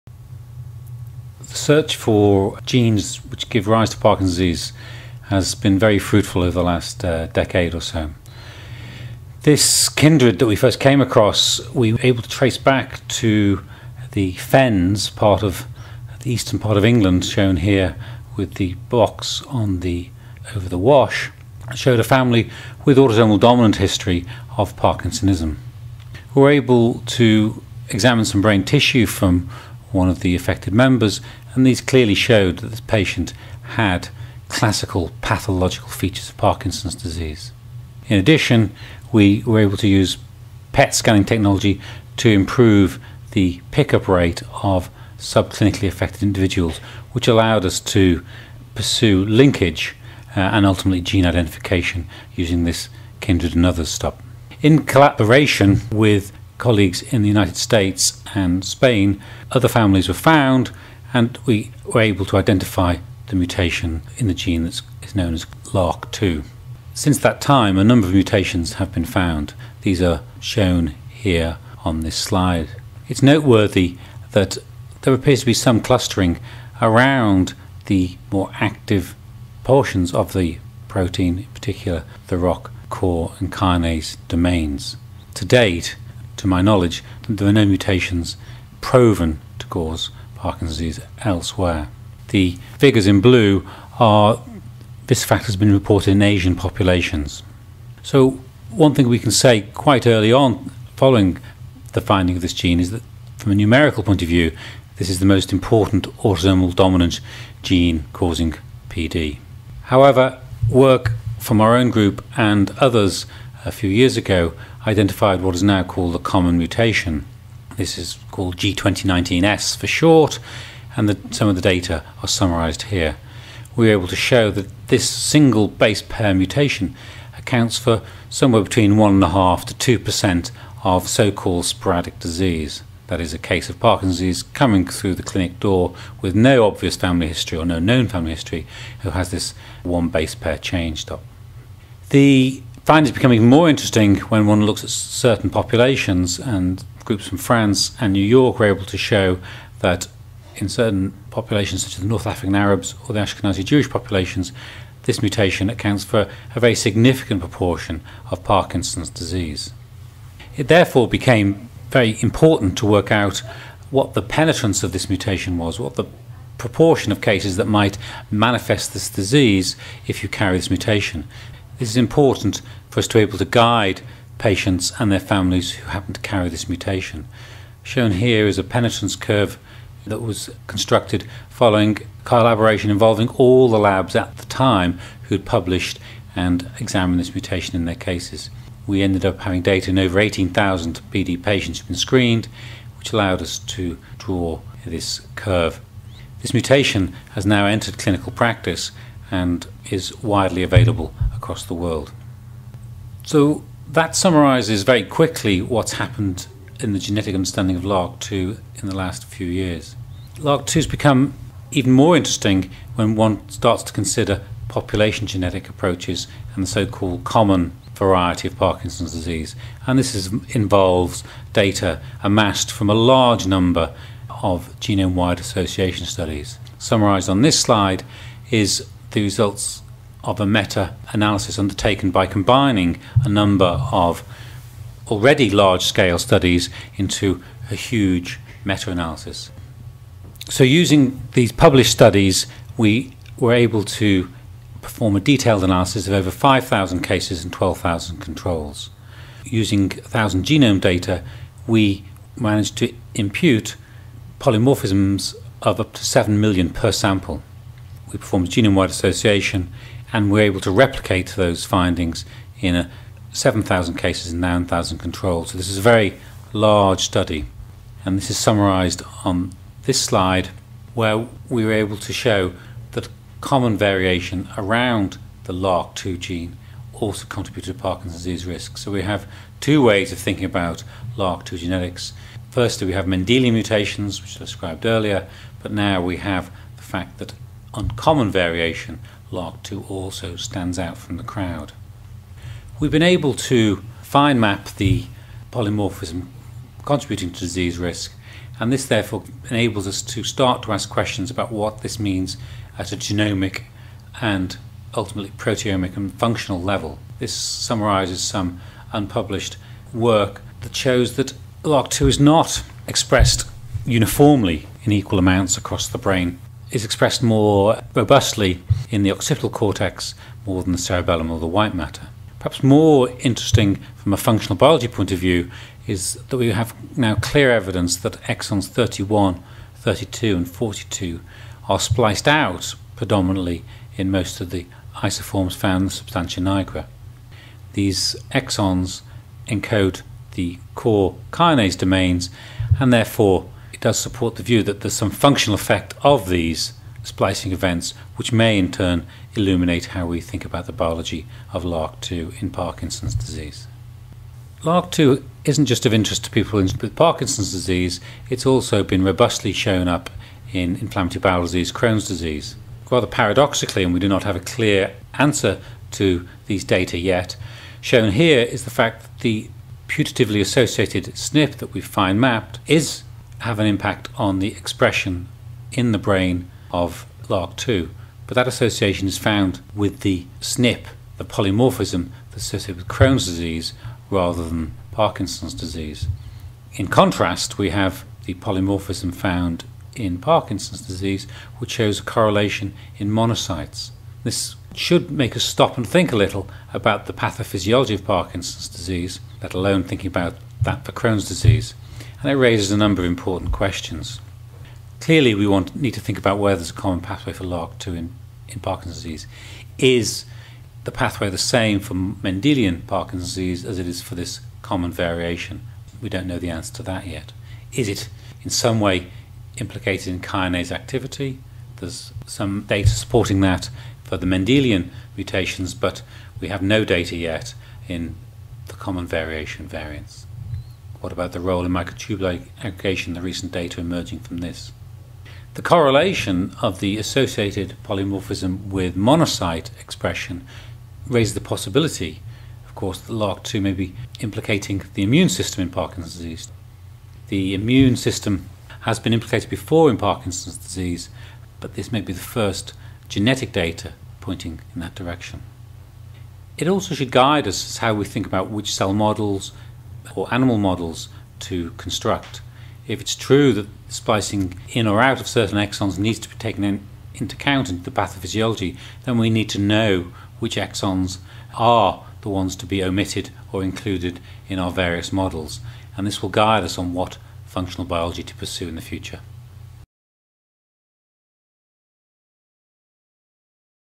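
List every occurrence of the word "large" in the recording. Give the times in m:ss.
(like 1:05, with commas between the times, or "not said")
3:42, 3:55, 4:26.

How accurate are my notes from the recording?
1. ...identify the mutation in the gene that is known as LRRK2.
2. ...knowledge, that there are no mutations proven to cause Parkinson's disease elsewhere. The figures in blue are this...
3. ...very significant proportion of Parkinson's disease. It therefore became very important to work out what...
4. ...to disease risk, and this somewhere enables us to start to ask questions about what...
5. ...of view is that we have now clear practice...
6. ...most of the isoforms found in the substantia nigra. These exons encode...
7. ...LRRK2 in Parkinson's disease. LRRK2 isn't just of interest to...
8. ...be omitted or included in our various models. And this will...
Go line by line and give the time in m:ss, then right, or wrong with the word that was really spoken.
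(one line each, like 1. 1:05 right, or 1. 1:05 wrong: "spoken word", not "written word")
1. 1:02 right
2. 1:26 right
3. 2:36 right
4. 4:57 wrong: "therefore", not "somewhere"
5. 5:25 wrong: "evidence", not "practice"
6. 5:34 right
7. 5:51 right
8. 7:52 right.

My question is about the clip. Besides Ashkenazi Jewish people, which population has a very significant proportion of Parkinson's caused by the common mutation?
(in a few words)
North African Arabs.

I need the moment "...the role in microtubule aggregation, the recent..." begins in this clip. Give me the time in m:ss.
7:11.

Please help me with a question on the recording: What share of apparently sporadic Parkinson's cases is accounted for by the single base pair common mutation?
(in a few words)
1.5 to 2%.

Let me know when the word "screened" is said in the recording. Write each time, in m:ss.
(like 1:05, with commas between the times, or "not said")
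3:11.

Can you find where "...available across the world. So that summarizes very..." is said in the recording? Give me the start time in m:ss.
3:20.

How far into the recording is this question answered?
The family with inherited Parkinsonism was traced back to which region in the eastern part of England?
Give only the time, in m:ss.
0:14.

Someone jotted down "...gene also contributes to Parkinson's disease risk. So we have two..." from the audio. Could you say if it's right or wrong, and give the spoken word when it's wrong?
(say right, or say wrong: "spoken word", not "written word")
right.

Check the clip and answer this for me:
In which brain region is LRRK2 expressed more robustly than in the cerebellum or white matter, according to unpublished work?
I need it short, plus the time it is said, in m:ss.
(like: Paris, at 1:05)
occipital cortex, at 5:19.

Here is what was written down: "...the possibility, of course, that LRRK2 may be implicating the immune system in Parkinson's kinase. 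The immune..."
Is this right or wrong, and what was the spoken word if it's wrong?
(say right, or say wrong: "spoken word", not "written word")
wrong: "disease", not "kinase".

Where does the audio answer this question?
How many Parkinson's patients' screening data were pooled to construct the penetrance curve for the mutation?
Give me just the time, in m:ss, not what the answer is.
3:09.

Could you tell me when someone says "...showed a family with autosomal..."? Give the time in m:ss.
0:21.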